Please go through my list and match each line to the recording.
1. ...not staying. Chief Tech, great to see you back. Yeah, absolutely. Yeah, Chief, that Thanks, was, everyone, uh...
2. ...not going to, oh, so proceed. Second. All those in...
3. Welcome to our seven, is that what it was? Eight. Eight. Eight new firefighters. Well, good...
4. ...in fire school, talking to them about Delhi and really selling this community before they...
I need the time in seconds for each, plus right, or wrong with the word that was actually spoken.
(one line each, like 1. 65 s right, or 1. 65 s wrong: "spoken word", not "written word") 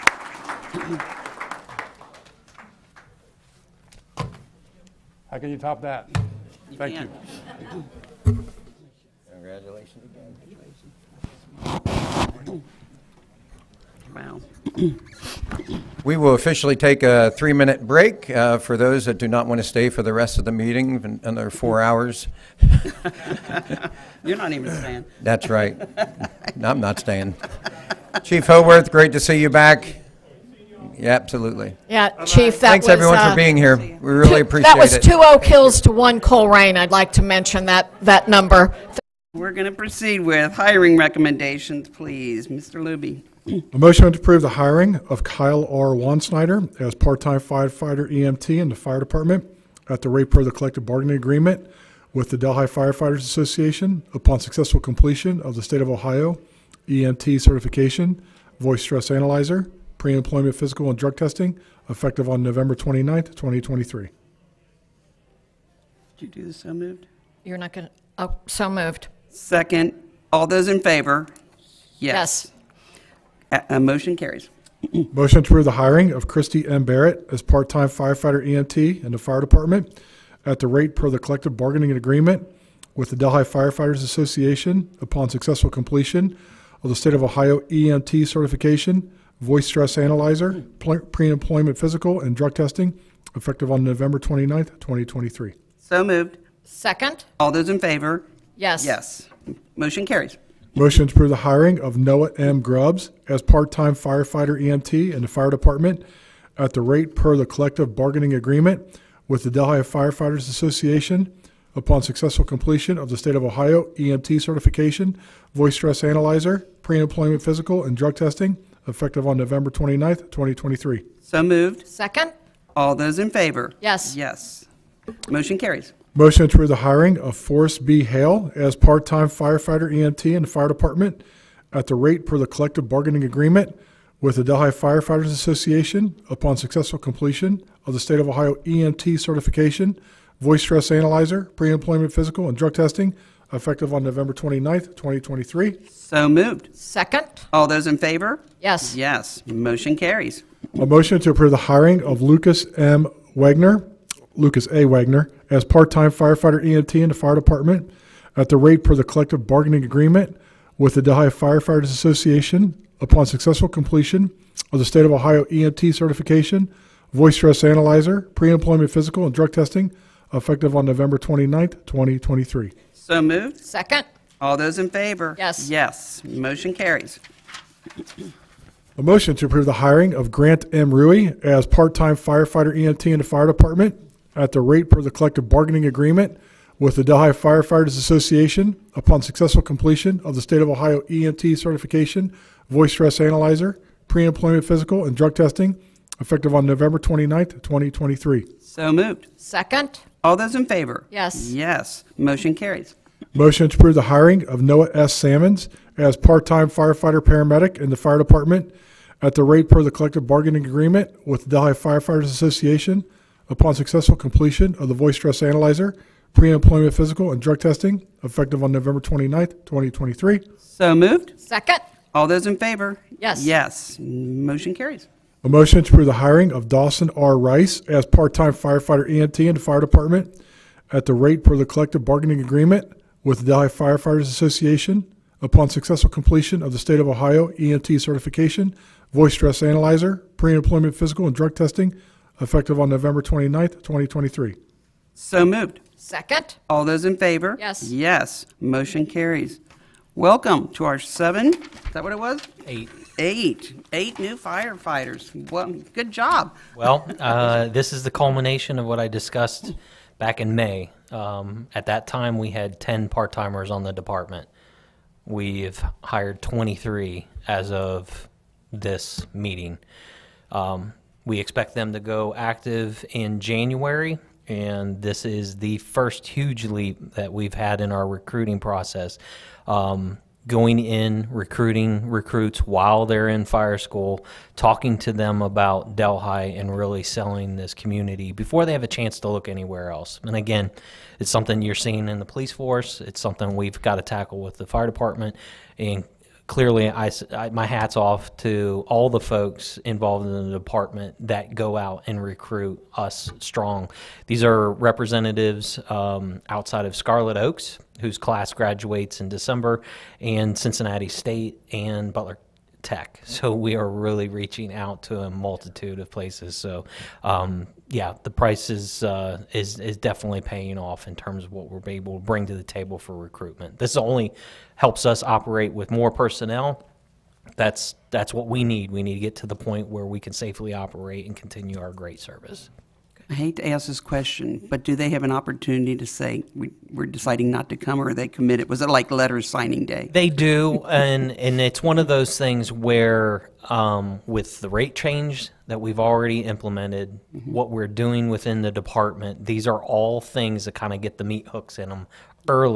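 1. 26 s wrong: "Howarth", not "Tech"
2. 67 s wrong: "moved", not "proceed"
3. 250 s right
4. 283 s right.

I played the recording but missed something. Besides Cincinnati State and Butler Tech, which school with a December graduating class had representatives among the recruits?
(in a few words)
Scarlet Oaks.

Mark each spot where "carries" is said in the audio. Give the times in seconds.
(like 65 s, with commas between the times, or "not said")
74 s, 100 s, 125 s, 149 s, 176 s, 202 s, 224 s, 249 s.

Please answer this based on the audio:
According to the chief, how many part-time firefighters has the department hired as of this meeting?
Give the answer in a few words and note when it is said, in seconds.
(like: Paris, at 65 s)
23, at 266 s.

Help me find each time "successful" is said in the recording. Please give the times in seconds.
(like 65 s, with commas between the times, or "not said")
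54 s, 85 s, 112 s, 136 s, 163 s, 189 s, 213 s, 235 s.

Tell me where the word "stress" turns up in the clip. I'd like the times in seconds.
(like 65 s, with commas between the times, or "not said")
58 s, 89 s, 115 s, 140 s, 167 s, 192 s, 215 s, 239 s.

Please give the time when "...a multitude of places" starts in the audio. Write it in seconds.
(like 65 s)
315 s.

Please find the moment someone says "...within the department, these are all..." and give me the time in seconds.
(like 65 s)
348 s.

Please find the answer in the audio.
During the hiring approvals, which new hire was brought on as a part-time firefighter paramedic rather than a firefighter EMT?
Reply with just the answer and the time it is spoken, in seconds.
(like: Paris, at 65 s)
Noah S. Salmons, at 204 s.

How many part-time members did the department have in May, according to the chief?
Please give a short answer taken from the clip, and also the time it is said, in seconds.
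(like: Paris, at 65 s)
10, at 262 s.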